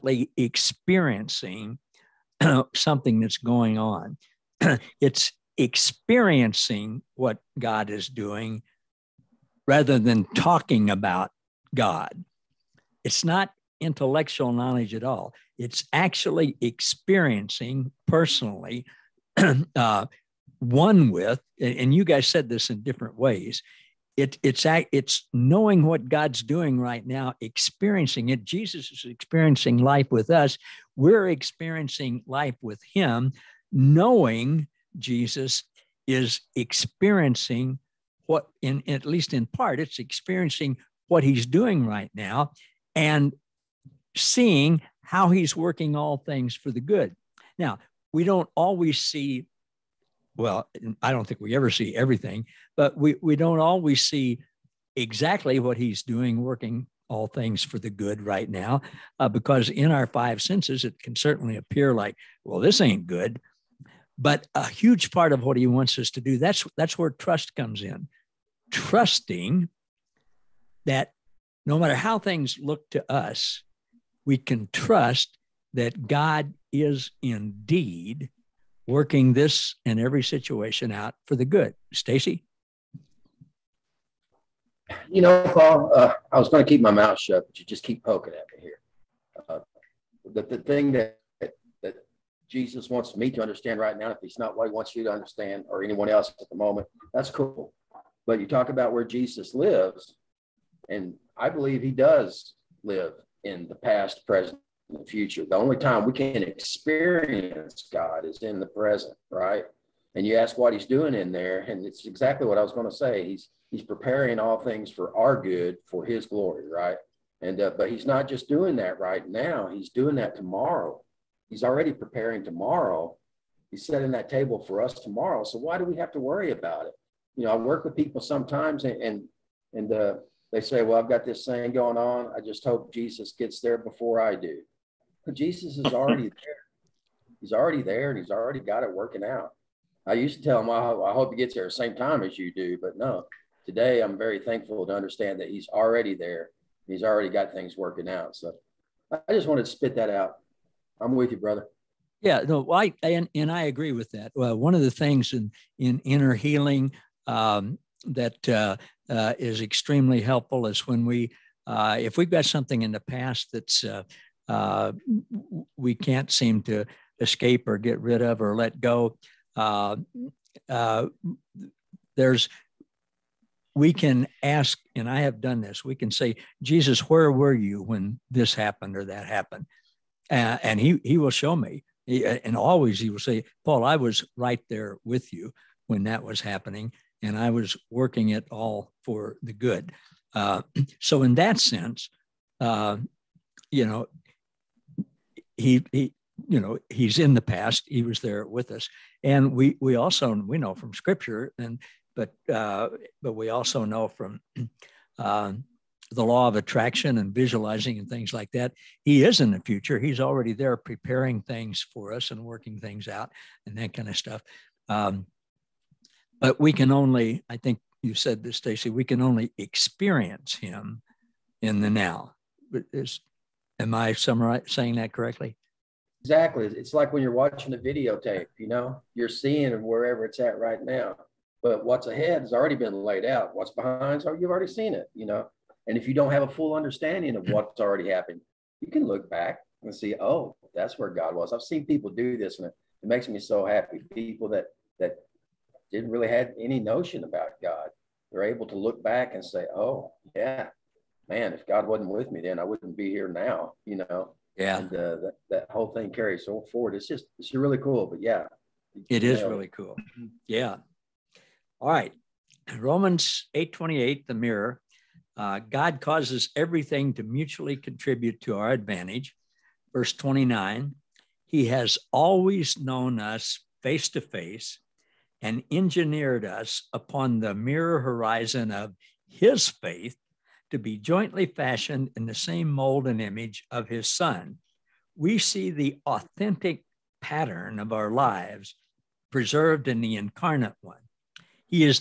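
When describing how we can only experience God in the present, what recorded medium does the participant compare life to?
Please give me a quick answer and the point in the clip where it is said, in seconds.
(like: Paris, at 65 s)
videotape, at 227 s.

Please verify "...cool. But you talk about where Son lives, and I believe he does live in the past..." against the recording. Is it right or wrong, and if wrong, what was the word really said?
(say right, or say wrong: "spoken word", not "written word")
wrong: "Jesus", not "Son".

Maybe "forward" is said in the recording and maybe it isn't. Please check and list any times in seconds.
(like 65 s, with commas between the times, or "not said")
256 s.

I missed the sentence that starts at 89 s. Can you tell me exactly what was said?
Uh, the, the thing that Jesus wants me to understand right now.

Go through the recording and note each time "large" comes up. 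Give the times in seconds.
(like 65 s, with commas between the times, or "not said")
not said.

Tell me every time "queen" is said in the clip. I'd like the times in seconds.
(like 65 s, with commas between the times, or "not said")
not said.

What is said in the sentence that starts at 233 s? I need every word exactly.
What's behind, so you've already seen it, you know.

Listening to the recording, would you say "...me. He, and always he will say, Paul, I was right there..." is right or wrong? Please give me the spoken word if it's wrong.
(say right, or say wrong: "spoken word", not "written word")
right.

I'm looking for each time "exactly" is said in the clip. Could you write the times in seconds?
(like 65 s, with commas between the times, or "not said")
54 s, 112 s, 226 s.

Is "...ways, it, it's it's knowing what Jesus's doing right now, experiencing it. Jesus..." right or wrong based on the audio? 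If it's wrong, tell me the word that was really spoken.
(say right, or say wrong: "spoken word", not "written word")
wrong: "God", not "Jesus".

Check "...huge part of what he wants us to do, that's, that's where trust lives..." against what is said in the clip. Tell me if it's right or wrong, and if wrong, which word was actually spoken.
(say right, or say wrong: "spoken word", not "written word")
wrong: "comes", not "lives".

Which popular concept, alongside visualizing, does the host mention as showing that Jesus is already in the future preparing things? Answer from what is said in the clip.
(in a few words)
law of attraction.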